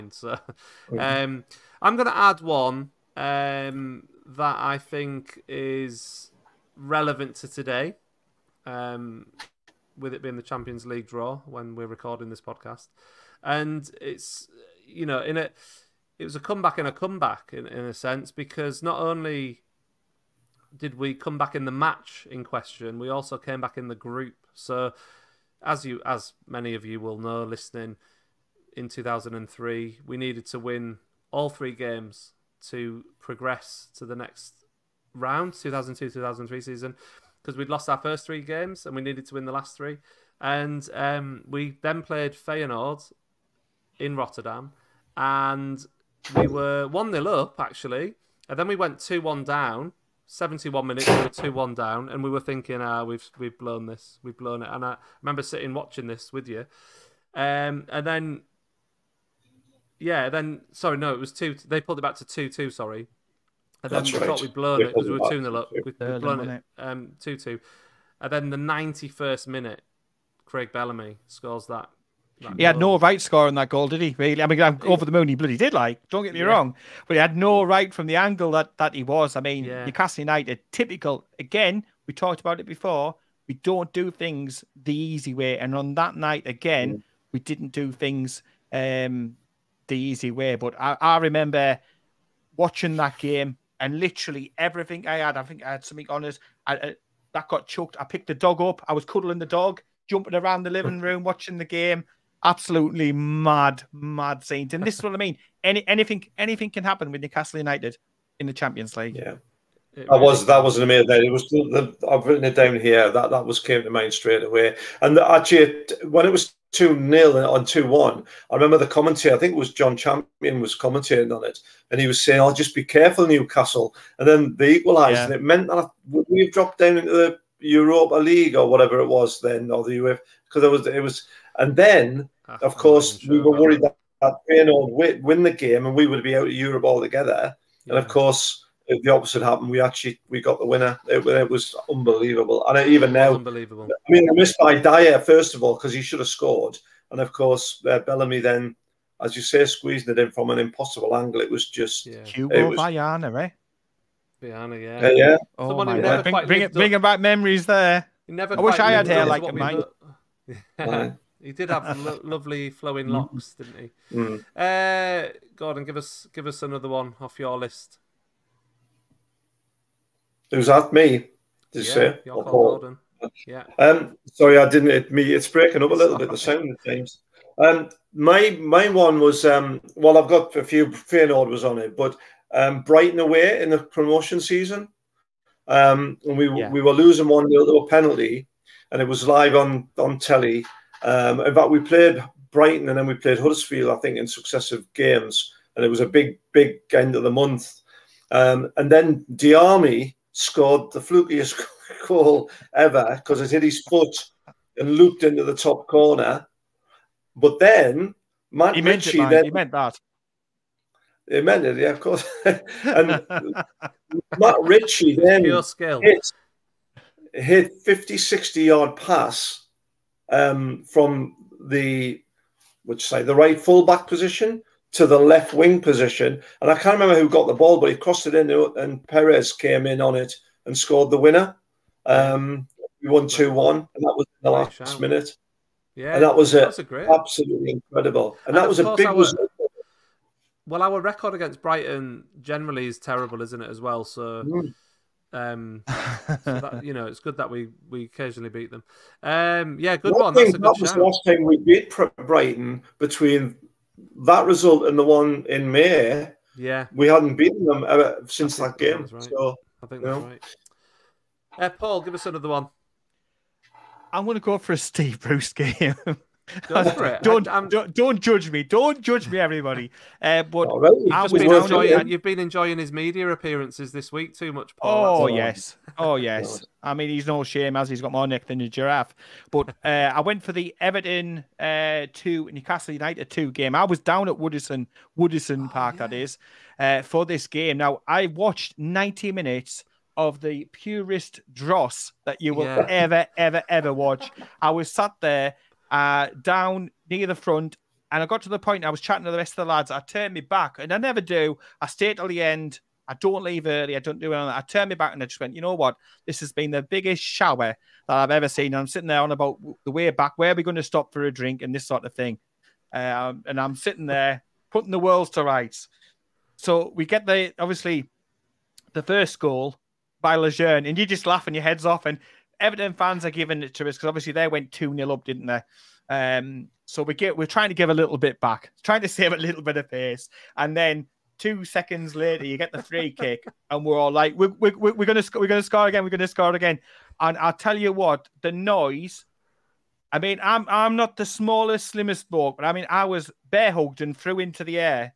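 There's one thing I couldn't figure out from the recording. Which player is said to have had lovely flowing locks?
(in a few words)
Hugo Viana.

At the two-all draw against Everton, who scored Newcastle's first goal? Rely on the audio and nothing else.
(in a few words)
Lejeune.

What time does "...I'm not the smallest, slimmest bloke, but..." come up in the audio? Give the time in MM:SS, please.
05:40.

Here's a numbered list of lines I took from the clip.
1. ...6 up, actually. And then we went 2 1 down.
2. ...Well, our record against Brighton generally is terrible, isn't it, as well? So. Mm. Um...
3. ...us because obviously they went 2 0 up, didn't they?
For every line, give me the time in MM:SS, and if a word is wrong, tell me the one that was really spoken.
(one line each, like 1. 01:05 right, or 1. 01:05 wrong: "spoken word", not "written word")
1. 00:47 wrong: "0", not "6"
2. 04:00 right
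3. 05:23 right.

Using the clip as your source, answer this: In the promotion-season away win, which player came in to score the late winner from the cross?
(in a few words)
Perez.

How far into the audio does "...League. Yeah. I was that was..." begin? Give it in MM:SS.
01:48.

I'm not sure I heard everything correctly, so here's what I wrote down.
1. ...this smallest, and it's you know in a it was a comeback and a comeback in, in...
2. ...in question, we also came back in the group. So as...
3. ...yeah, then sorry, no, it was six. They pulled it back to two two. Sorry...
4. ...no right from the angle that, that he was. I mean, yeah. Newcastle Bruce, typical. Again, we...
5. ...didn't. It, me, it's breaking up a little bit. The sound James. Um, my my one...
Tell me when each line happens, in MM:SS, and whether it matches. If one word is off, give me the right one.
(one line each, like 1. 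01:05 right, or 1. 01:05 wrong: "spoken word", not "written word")
1. 00:12 wrong: "podcast", not "smallest"
2. 00:22 right
3. 01:00 wrong: "two", not "six"
4. 01:17 wrong: "United", not "Bruce"
5. 02:54 right.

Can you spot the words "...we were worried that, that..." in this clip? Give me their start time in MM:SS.
02:13.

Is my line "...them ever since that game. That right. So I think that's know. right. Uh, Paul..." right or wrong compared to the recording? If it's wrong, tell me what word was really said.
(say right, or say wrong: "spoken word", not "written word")
right.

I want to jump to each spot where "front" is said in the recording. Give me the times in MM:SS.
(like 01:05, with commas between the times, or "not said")
04:57.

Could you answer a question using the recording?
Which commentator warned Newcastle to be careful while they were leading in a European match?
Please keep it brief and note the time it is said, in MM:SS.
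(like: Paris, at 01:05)
John Champion, at 01:59.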